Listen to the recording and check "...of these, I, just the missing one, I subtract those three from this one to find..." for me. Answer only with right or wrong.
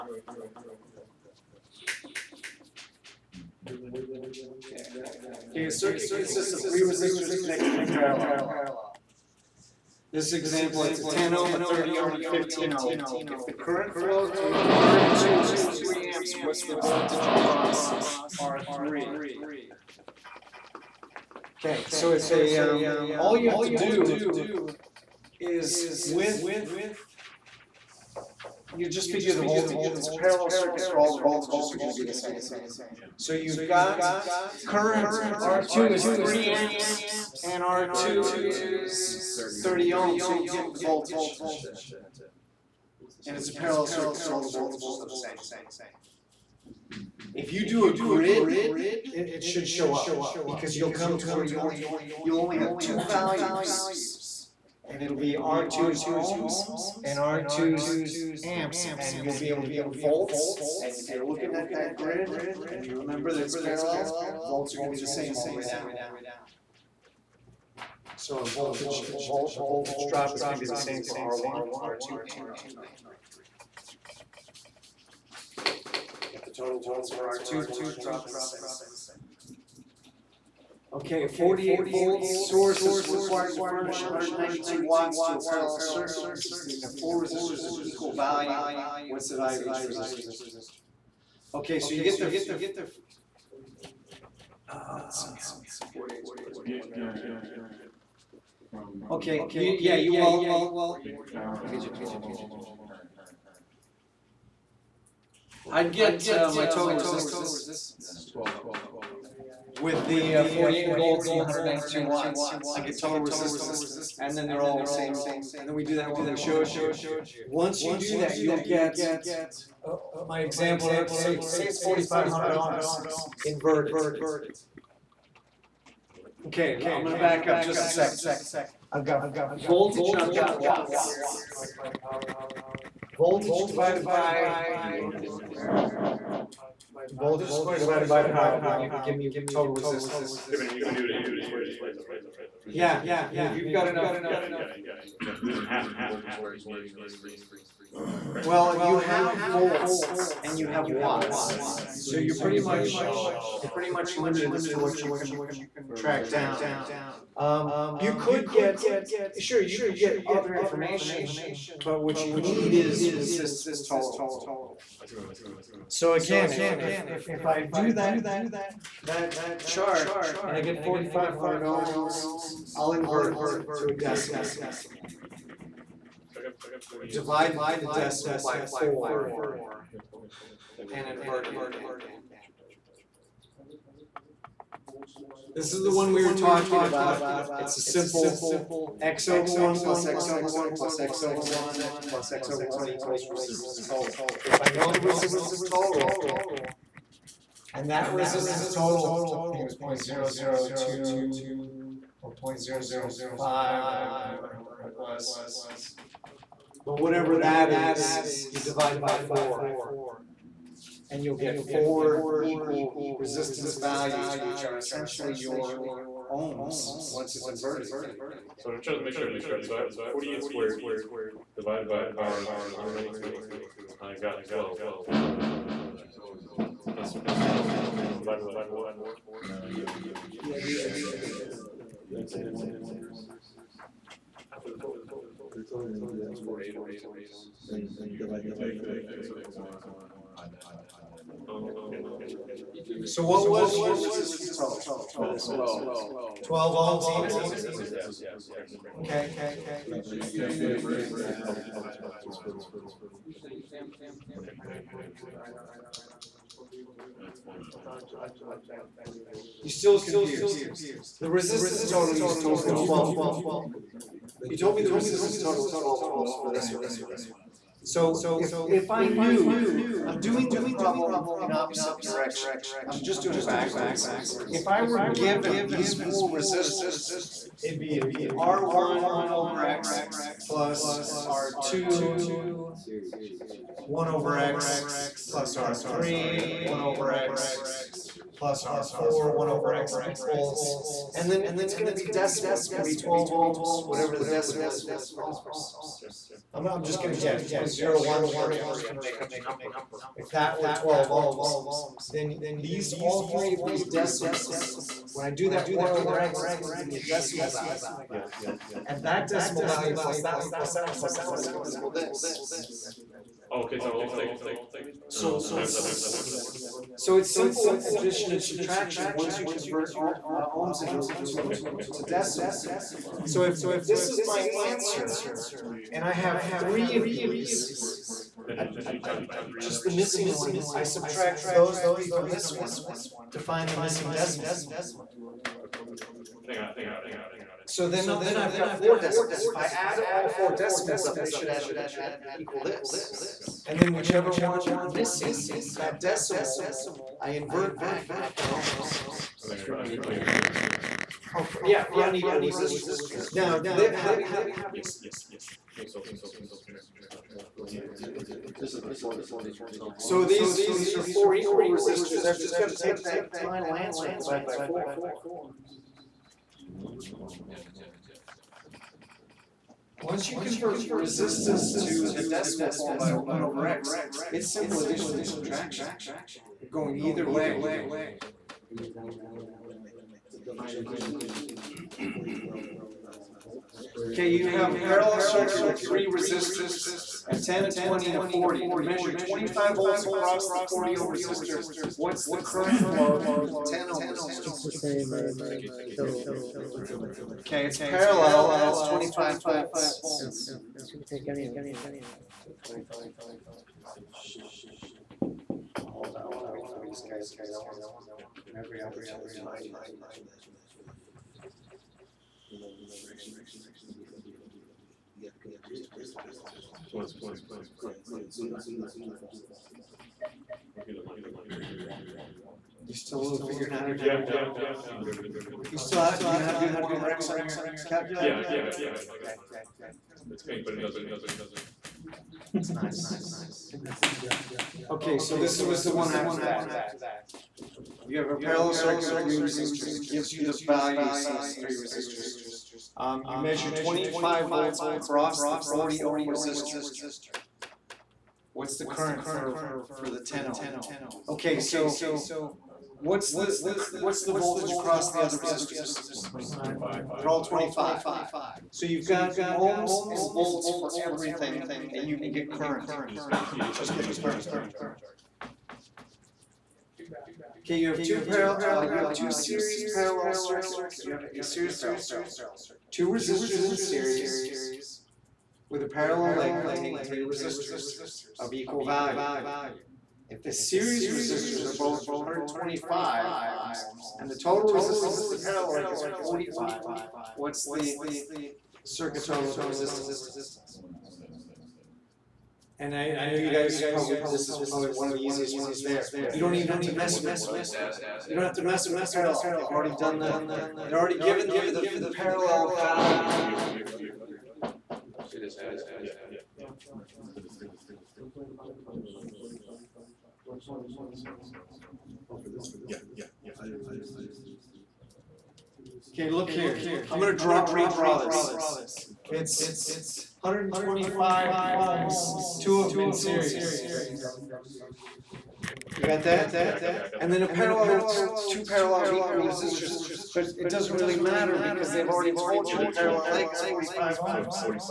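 right.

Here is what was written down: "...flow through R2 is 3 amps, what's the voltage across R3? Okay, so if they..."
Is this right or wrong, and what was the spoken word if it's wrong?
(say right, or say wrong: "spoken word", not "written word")
right.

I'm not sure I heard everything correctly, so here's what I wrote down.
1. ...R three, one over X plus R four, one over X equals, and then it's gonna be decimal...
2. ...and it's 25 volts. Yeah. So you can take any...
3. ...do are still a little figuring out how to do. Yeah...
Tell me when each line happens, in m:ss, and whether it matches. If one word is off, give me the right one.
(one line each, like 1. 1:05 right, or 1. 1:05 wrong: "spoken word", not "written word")
1. 4:45 right
2. 6:38 right
3. 7:01 right.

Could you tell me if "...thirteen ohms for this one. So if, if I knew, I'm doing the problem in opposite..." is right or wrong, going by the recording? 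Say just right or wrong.
wrong.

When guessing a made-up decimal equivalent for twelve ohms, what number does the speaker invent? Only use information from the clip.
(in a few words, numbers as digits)
0.013.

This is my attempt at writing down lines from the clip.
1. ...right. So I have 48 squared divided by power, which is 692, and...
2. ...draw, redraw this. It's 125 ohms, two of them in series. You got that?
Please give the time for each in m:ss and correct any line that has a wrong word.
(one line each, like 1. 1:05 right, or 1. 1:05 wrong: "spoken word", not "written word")
1. 3:39 wrong: "192", not "692"
2. 8:37 right.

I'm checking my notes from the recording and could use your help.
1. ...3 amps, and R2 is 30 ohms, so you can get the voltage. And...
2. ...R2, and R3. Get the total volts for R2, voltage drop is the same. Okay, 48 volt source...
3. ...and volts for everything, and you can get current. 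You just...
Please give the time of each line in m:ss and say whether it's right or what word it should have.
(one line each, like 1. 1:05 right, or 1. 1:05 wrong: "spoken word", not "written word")
1. 0:36 right
2. 1:11 right
3. 7:40 right.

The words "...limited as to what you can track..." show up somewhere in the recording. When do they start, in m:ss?
2:34.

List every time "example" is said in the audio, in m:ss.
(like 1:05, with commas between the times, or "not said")
0:10, 2:00.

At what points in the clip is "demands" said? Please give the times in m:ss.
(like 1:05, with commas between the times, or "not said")
not said.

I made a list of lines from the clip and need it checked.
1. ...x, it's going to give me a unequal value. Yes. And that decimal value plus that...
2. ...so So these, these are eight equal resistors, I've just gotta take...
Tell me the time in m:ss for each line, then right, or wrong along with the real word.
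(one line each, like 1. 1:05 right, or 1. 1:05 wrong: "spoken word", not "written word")
1. 5:06 wrong: "decimal", not "unequal"
2. 5:59 wrong: "four", not "eight".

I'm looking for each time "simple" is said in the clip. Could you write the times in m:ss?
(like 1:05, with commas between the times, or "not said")
3:07, 5:17, 6:14.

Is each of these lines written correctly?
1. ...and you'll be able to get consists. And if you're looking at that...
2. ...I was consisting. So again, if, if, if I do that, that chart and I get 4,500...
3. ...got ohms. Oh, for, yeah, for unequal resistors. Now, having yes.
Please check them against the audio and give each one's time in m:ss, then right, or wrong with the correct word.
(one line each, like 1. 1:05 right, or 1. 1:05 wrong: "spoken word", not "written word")
1. 0:58 wrong: "volts", not "consists"
2. 2:45 wrong: "thinking", not "consisting"
3. 5:48 right.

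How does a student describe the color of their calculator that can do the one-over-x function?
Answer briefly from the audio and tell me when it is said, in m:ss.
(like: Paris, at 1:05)
pink, at 7:10.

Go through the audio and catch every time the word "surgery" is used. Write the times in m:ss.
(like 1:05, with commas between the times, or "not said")
not said.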